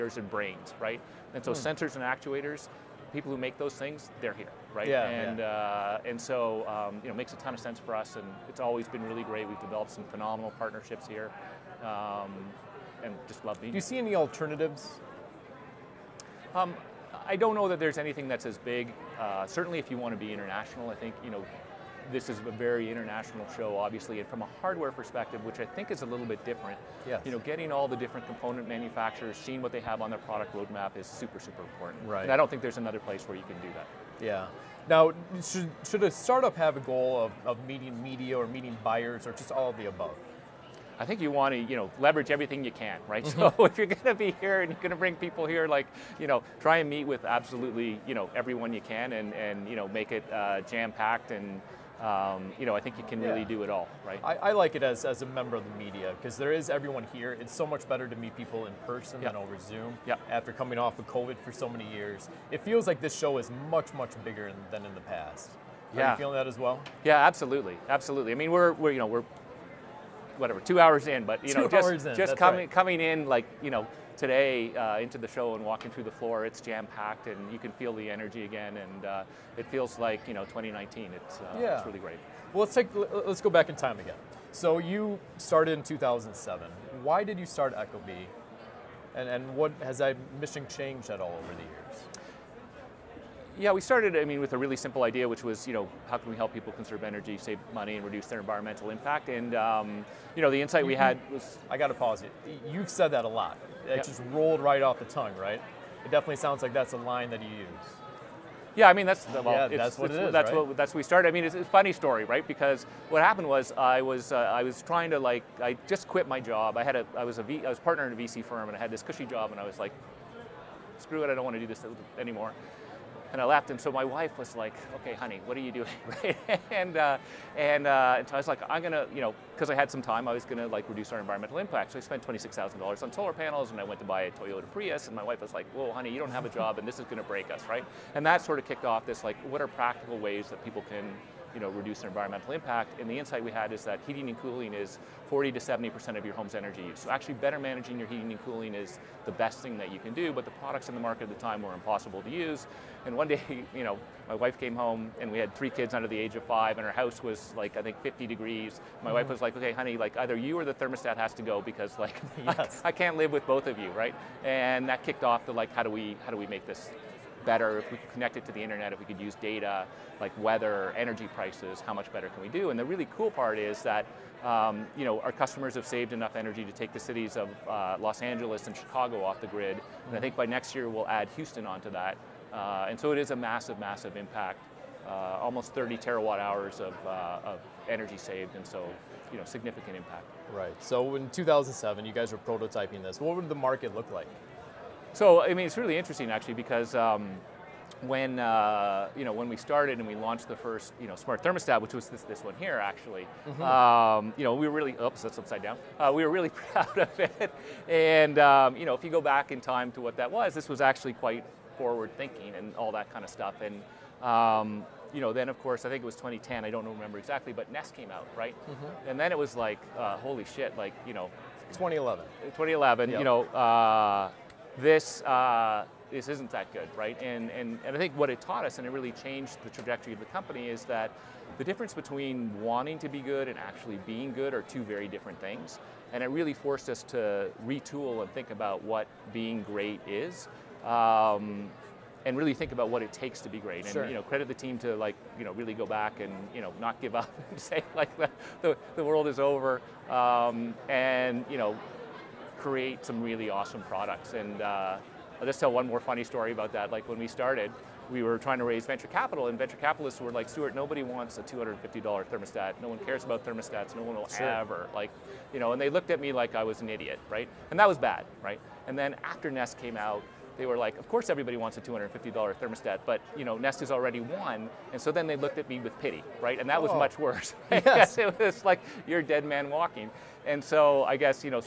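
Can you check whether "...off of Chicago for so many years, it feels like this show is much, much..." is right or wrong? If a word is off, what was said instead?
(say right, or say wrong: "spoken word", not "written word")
wrong: "COVID", not "Chicago".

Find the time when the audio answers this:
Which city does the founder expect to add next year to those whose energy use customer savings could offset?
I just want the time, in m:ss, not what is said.
3:01.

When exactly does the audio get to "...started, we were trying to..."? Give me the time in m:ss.
4:17.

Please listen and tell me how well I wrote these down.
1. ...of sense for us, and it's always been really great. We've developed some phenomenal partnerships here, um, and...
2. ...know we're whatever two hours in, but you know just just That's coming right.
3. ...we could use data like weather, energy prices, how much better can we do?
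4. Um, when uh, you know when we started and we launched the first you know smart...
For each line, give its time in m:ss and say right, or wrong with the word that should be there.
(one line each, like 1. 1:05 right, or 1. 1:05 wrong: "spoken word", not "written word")
1. 0:07 right
2. 1:08 right
3. 2:48 right
4. 3:16 right.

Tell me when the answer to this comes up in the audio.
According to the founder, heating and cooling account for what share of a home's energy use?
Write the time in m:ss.
2:25.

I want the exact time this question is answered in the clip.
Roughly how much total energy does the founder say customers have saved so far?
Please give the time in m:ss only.
3:05.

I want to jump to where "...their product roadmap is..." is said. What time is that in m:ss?
0:30.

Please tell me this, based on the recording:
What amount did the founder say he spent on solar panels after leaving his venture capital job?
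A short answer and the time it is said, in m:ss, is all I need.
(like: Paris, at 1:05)
$26,000, at 2:12.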